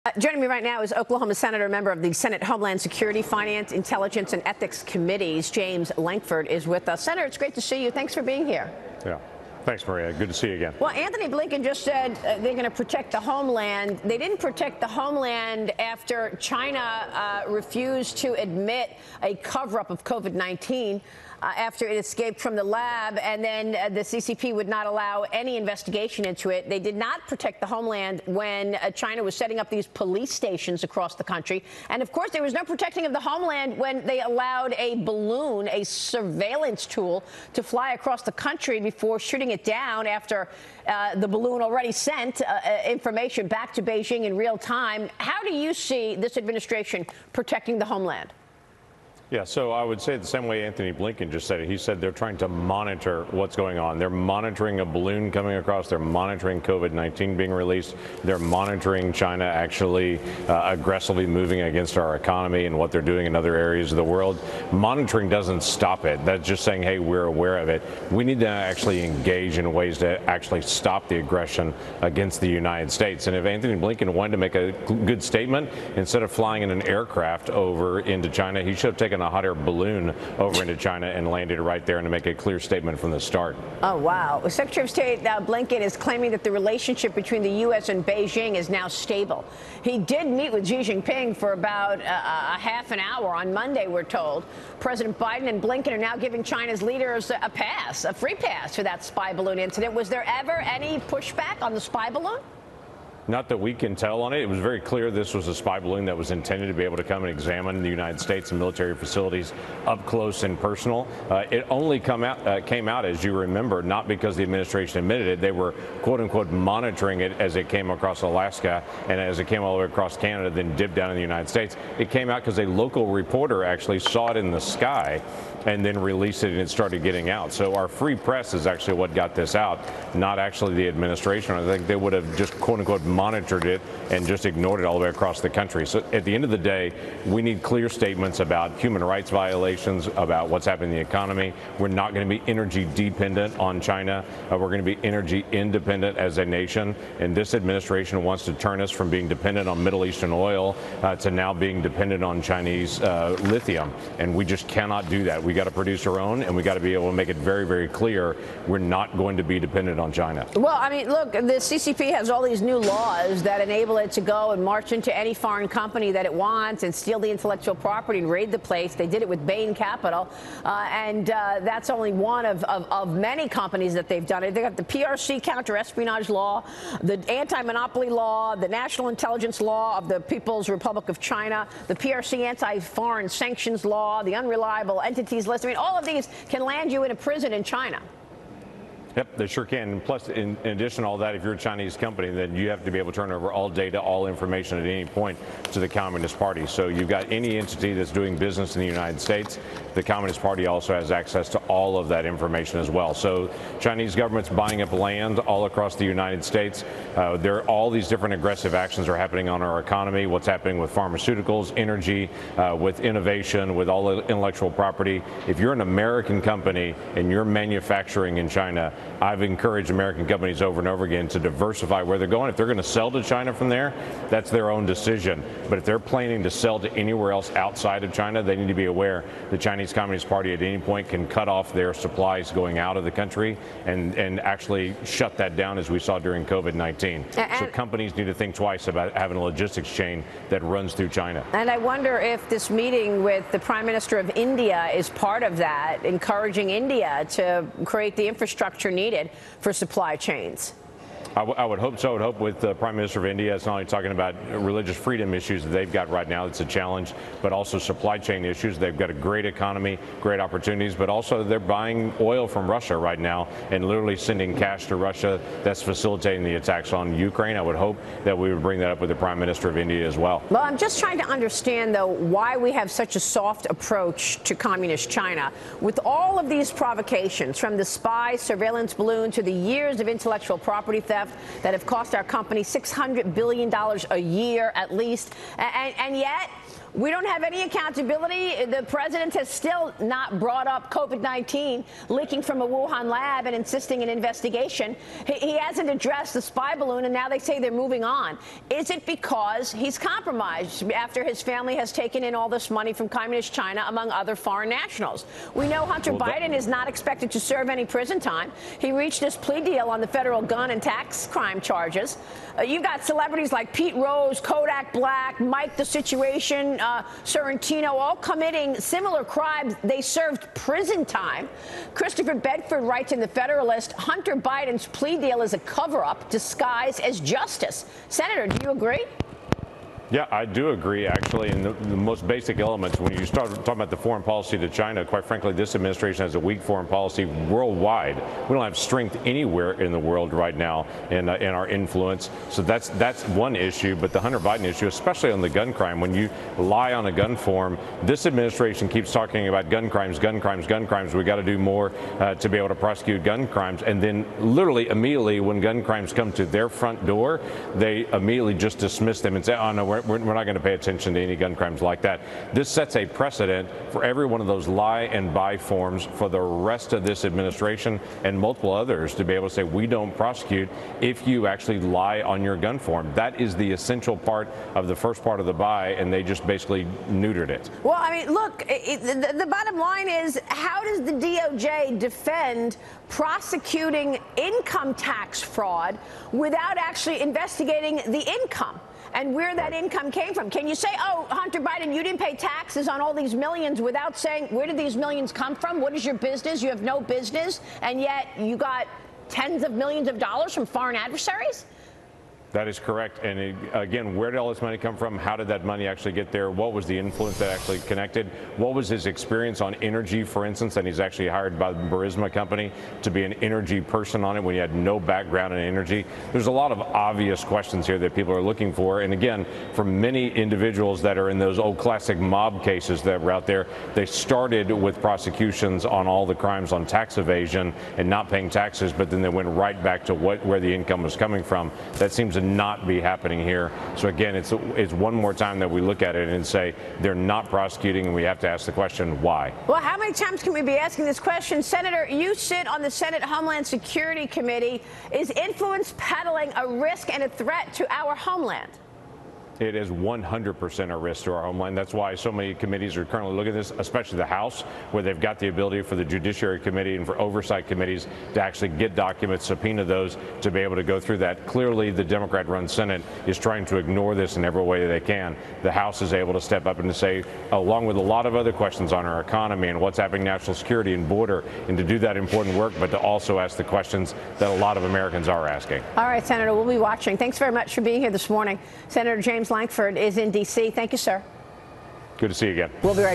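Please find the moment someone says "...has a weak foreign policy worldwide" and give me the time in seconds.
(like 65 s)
336 s.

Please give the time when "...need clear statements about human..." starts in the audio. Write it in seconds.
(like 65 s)
137 s.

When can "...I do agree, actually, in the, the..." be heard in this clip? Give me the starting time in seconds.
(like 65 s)
330 s.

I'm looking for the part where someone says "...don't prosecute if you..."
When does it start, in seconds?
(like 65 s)
369 s.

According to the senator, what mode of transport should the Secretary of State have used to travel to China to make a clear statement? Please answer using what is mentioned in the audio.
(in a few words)
Hot air balloon.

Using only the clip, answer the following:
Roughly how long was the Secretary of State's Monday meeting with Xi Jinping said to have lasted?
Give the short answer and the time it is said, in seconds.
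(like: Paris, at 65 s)
Half an hour, at 92 s.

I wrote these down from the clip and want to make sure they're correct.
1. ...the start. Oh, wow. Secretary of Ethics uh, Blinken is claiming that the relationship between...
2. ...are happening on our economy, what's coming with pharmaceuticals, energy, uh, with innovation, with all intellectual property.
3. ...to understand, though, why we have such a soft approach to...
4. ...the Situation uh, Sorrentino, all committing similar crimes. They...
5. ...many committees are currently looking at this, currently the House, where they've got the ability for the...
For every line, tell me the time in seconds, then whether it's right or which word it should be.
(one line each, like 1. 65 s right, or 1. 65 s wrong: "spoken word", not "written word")
1. 83 s wrong: "State", not "Ethics"
2. 209 s wrong: "happening", not "coming"
3. 271 s right
4. 315 s right
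5. 452 s wrong: "especially", not "currently".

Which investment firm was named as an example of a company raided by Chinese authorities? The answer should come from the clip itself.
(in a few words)
Bain Capital.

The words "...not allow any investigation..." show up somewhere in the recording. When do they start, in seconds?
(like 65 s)
24 s.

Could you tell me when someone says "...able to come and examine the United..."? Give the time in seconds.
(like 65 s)
106 s.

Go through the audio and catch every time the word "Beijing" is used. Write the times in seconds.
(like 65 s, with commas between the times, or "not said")
43 s, 88 s.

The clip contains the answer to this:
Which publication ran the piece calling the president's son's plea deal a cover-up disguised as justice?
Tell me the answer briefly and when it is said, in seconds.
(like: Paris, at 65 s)
The Federalist, at 323 s.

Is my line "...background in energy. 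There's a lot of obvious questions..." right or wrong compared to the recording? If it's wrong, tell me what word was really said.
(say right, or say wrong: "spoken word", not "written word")
right.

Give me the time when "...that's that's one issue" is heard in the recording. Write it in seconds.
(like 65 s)
342 s.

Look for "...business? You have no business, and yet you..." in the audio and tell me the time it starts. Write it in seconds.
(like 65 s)
396 s.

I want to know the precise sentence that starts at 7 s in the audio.
Senator, it's great to see you.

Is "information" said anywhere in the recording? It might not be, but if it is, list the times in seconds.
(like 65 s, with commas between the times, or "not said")
42 s, 194 s, 202 s.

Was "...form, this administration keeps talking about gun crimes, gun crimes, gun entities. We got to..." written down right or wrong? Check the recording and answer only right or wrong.
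wrong.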